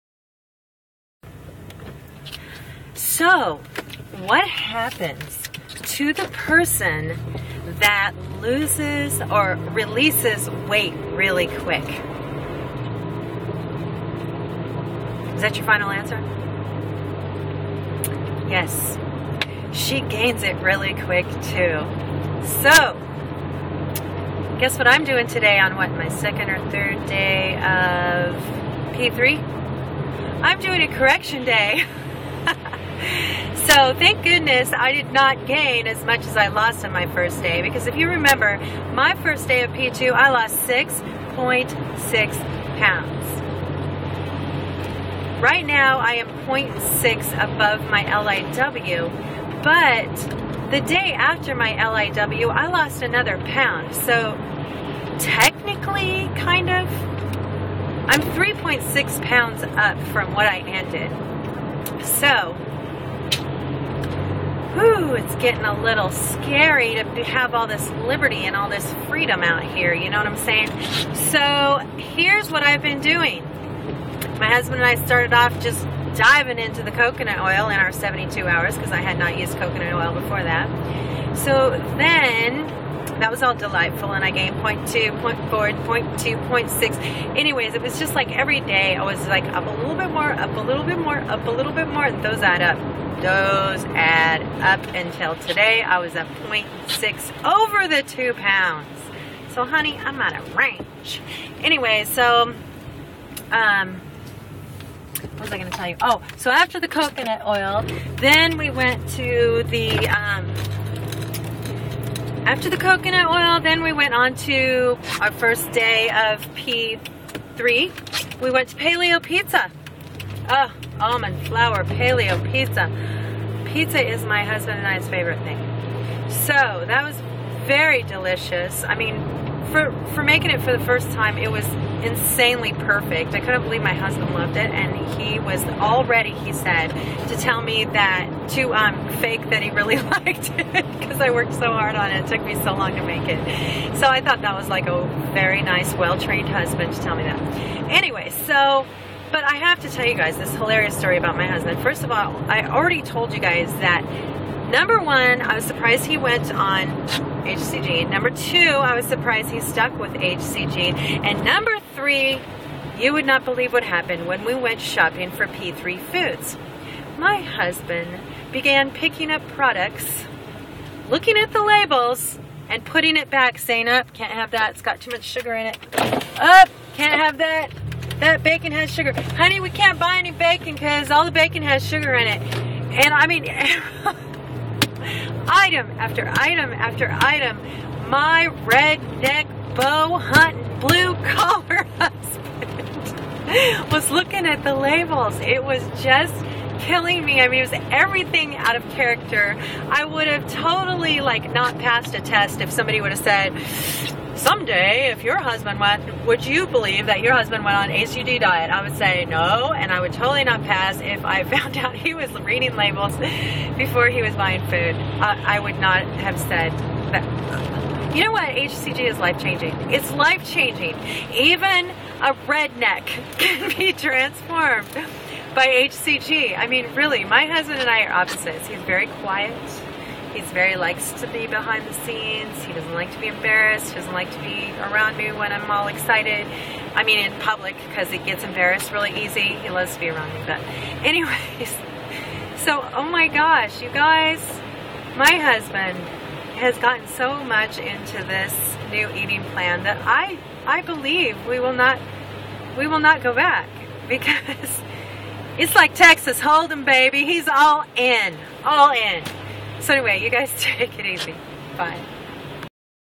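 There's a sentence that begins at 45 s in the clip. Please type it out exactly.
Right now, I am 0.6 above my LIW, but the day after my LIW, I lost another pound.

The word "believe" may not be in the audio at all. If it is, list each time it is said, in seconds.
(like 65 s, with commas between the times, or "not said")
133 s, 163 s, 206 s, 250 s.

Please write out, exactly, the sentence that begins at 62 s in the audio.
So whew, it's getting a little scary to have all this liberty and all this freedom out here.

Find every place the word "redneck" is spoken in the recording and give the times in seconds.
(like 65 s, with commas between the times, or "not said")
188 s, 222 s.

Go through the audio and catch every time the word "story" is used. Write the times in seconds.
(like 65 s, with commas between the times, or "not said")
150 s.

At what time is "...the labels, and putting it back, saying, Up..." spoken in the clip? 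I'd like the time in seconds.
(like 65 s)
171 s.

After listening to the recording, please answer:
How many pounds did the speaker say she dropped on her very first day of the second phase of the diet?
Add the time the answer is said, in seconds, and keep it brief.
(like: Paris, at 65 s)
6.6, at 40 s.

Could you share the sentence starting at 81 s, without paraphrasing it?
So then that was all delightful and I gained point two, point four, point two, point six.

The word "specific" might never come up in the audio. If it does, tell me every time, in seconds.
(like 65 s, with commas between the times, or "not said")
not said.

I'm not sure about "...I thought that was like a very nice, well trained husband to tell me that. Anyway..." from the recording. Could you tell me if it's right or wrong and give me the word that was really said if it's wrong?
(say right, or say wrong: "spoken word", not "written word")
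right.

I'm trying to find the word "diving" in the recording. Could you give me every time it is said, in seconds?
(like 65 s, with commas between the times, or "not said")
76 s.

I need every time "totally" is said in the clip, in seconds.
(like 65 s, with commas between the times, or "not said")
200 s, 210 s.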